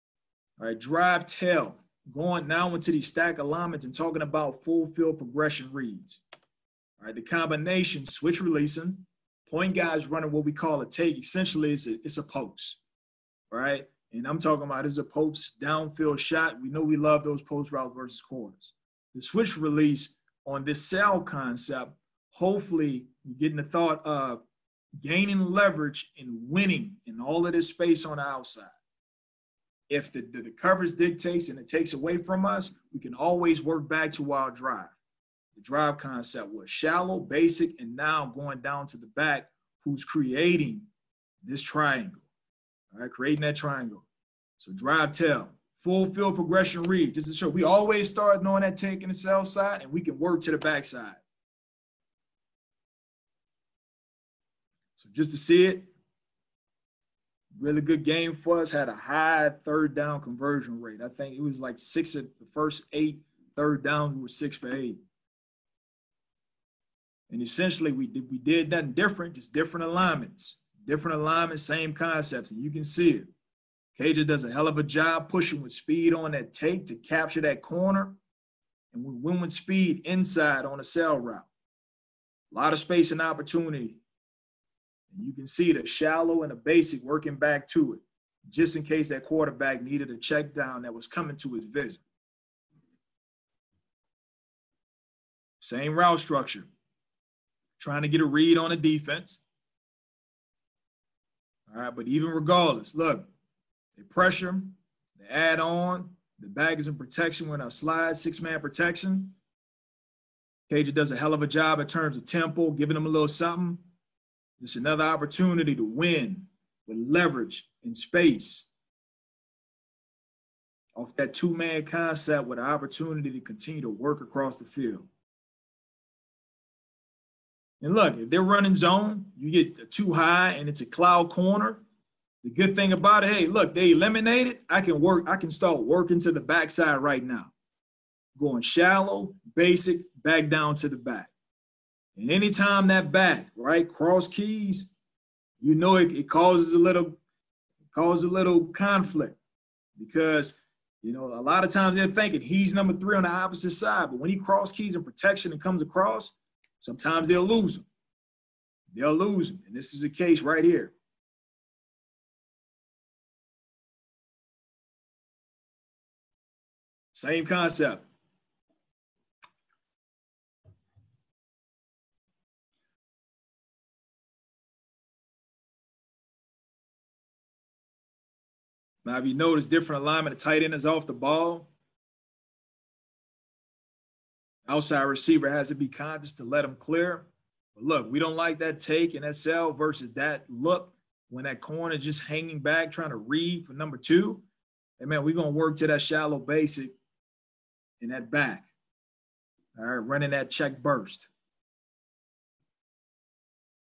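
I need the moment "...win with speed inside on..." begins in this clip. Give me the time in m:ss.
1:19.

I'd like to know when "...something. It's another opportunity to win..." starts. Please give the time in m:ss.
1:53.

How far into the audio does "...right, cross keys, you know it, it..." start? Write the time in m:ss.
2:23.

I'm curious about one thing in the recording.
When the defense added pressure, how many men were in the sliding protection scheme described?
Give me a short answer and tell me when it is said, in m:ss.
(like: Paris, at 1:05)
6, at 1:48.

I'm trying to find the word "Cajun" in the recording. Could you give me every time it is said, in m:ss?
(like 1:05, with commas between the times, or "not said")
1:13, 1:50.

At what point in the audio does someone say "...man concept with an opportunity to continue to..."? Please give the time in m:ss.
2:01.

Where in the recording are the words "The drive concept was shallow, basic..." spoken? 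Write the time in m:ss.
0:35.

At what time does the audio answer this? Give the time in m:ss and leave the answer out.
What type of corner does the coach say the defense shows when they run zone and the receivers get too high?
2:10.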